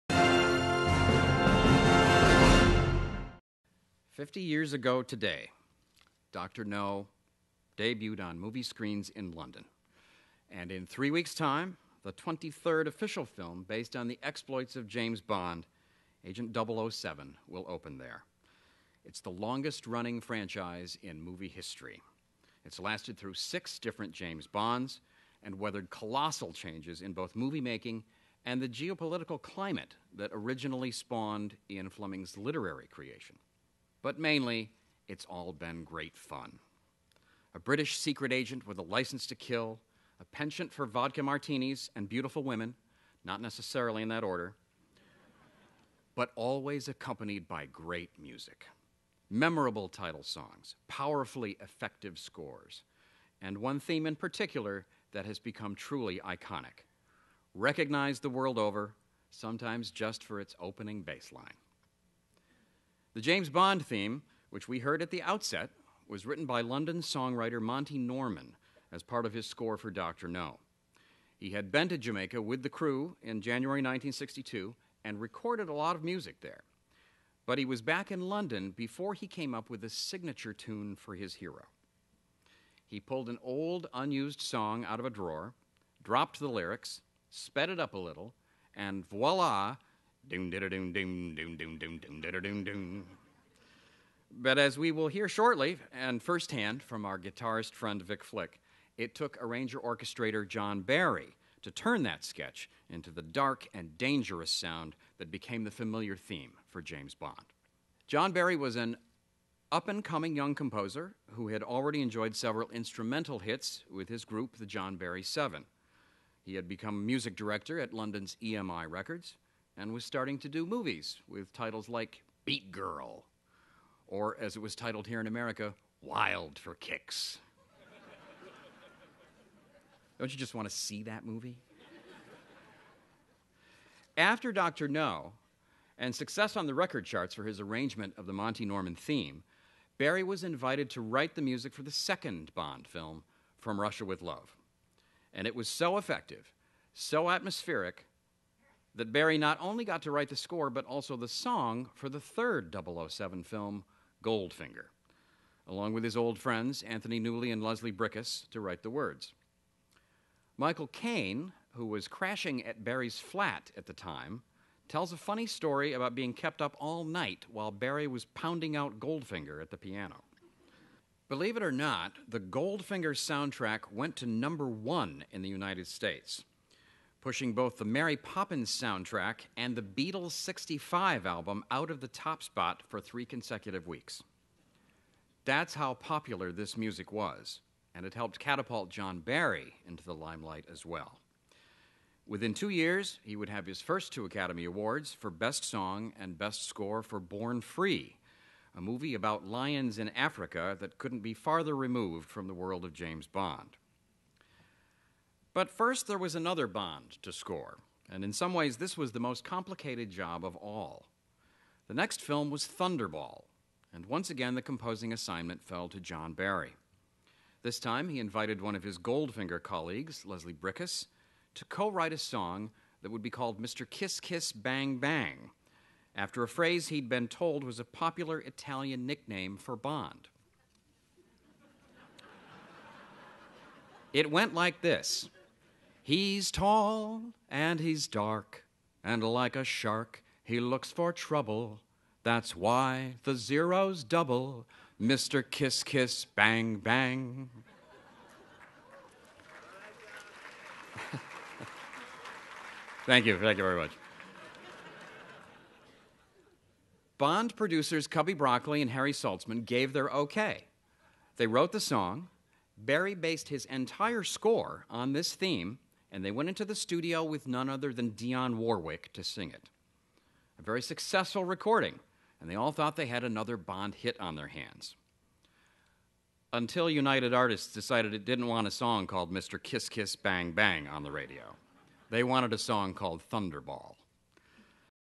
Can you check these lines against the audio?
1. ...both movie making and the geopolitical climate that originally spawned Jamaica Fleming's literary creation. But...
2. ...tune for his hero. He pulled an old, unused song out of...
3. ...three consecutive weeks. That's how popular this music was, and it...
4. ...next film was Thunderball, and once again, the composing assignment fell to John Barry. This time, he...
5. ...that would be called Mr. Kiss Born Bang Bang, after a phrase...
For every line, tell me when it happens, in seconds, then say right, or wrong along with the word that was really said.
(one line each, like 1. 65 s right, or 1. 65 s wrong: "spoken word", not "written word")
1. 27 s wrong: "Ian", not "Jamaica"
2. 80 s right
3. 182 s right
4. 211 s right
5. 223 s wrong: "Kiss", not "Born".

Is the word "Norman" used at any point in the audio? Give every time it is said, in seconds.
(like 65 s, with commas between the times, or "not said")
67 s, 138 s.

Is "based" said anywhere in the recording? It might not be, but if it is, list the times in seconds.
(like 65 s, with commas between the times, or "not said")
13 s, 263 s.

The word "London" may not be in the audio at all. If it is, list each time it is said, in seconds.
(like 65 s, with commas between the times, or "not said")
9 s, 66 s, 78 s, 117 s.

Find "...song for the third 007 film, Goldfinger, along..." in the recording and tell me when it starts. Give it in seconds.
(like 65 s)
151 s.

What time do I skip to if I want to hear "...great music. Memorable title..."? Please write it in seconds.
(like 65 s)
47 s.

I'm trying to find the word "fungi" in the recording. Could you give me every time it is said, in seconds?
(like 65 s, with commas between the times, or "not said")
not said.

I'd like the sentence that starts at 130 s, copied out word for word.
Don't you just want to see that movie?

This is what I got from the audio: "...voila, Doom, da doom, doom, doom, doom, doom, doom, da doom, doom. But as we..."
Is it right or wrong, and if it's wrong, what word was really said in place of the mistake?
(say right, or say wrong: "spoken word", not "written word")
right.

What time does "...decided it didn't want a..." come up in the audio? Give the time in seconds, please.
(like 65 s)
277 s.